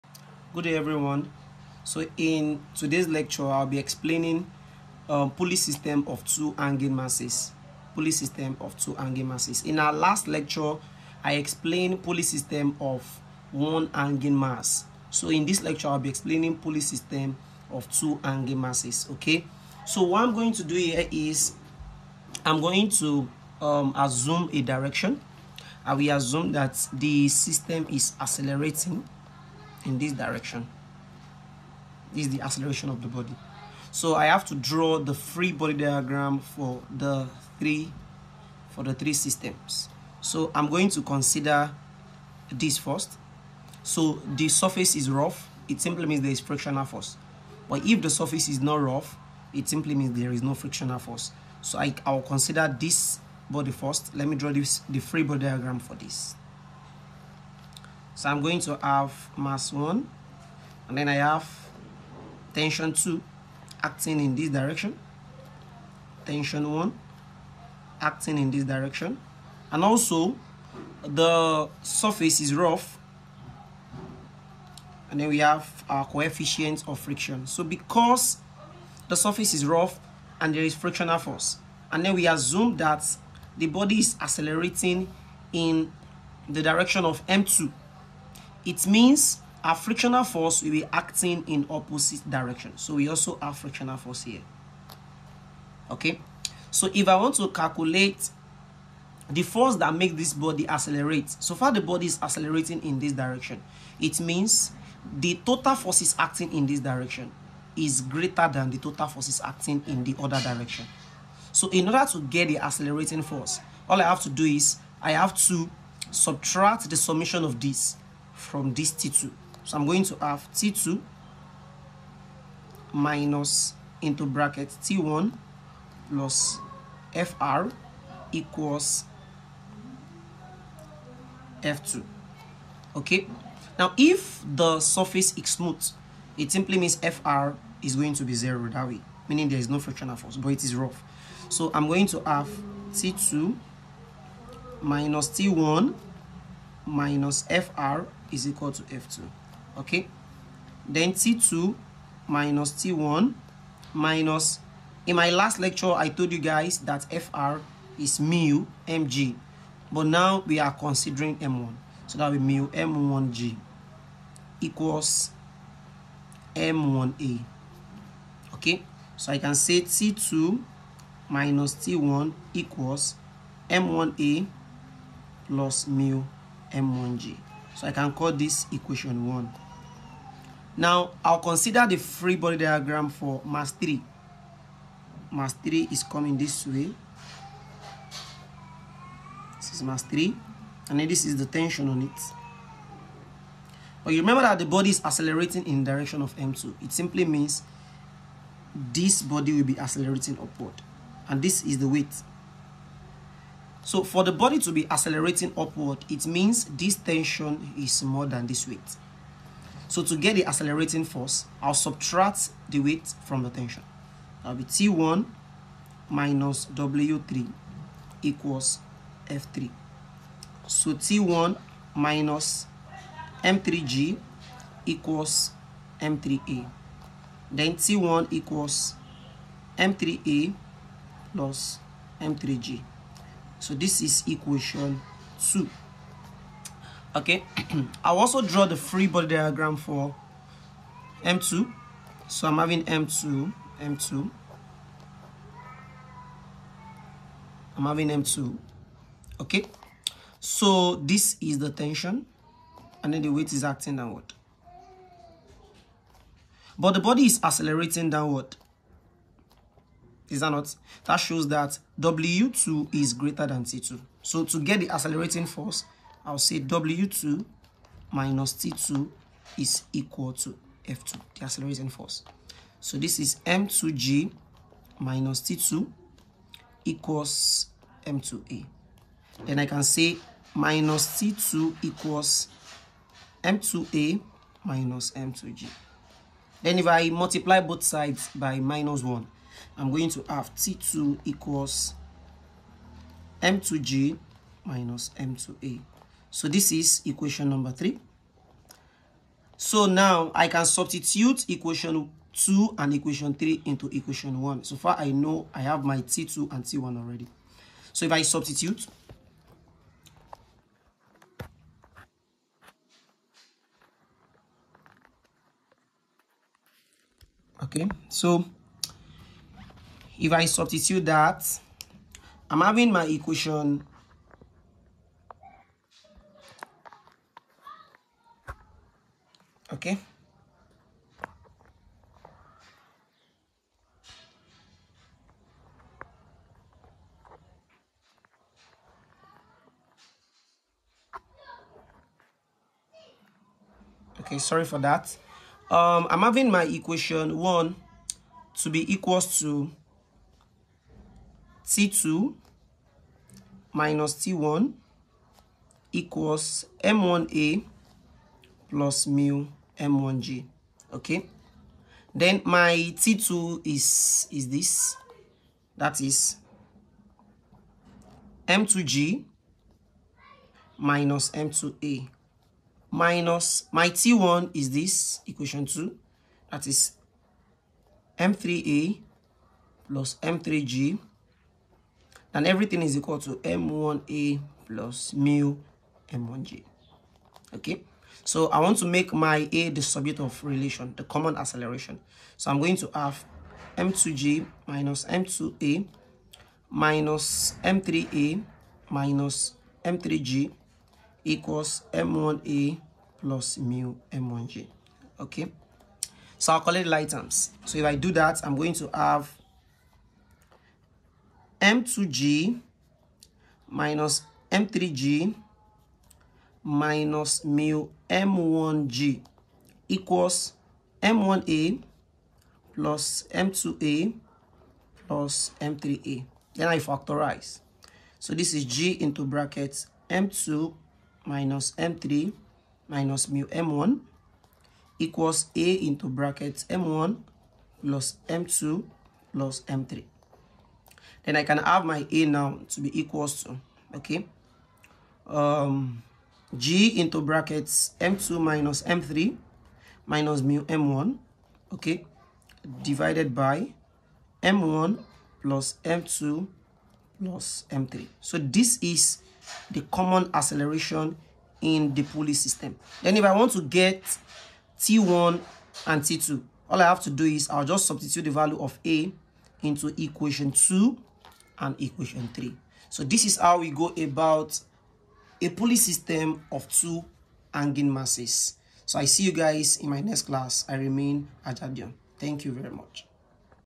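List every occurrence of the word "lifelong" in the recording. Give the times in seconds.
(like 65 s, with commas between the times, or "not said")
not said.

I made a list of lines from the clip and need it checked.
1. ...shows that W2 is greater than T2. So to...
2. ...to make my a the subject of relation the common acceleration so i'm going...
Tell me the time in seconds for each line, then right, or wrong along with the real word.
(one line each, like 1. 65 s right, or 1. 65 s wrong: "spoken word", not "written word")
1. 261 s right
2. 388 s right.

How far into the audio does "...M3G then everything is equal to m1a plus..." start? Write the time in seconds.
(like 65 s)
380 s.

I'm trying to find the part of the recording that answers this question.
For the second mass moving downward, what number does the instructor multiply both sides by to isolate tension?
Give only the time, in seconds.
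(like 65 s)
288 s.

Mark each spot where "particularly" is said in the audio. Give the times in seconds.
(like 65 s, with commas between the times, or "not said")
not said.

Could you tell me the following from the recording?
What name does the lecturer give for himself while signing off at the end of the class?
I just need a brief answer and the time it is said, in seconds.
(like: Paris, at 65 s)
Ajadion, at 481 s.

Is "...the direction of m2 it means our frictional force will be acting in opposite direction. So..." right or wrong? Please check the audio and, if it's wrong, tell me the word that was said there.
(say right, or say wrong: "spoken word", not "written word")
right.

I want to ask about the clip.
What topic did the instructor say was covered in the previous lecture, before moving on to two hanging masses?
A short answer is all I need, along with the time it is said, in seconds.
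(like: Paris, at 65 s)
Pulley system of one hanging mass, at 12 s.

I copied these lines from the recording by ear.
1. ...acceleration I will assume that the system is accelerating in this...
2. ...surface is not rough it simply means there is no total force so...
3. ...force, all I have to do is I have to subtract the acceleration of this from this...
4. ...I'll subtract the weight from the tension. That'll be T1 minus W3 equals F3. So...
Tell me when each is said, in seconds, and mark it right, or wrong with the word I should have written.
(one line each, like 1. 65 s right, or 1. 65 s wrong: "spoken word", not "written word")
1. 24 s wrong: "direction", not "acceleration"
2. 48 s wrong: "frictional", not "total"
3. 113 s wrong: "summation", not "acceleration"
4. 211 s right.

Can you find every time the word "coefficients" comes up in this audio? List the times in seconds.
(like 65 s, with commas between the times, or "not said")
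76 s.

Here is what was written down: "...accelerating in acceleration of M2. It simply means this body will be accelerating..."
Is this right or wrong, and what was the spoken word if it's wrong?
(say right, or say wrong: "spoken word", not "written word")
wrong: "direction", not "acceleration".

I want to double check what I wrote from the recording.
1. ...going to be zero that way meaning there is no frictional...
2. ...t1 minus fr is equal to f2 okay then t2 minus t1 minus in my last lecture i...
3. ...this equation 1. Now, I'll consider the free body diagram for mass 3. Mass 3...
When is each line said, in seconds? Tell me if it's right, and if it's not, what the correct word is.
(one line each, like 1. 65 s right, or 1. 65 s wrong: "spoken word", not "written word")
1. 137 s right
2. 145 s right
3. 178 s right.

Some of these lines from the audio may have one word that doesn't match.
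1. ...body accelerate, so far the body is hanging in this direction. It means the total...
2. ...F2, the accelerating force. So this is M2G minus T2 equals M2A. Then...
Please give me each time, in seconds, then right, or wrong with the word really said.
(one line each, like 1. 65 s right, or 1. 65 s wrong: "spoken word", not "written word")
1. 100 s wrong: "accelerating", not "hanging"
2. 270 s right.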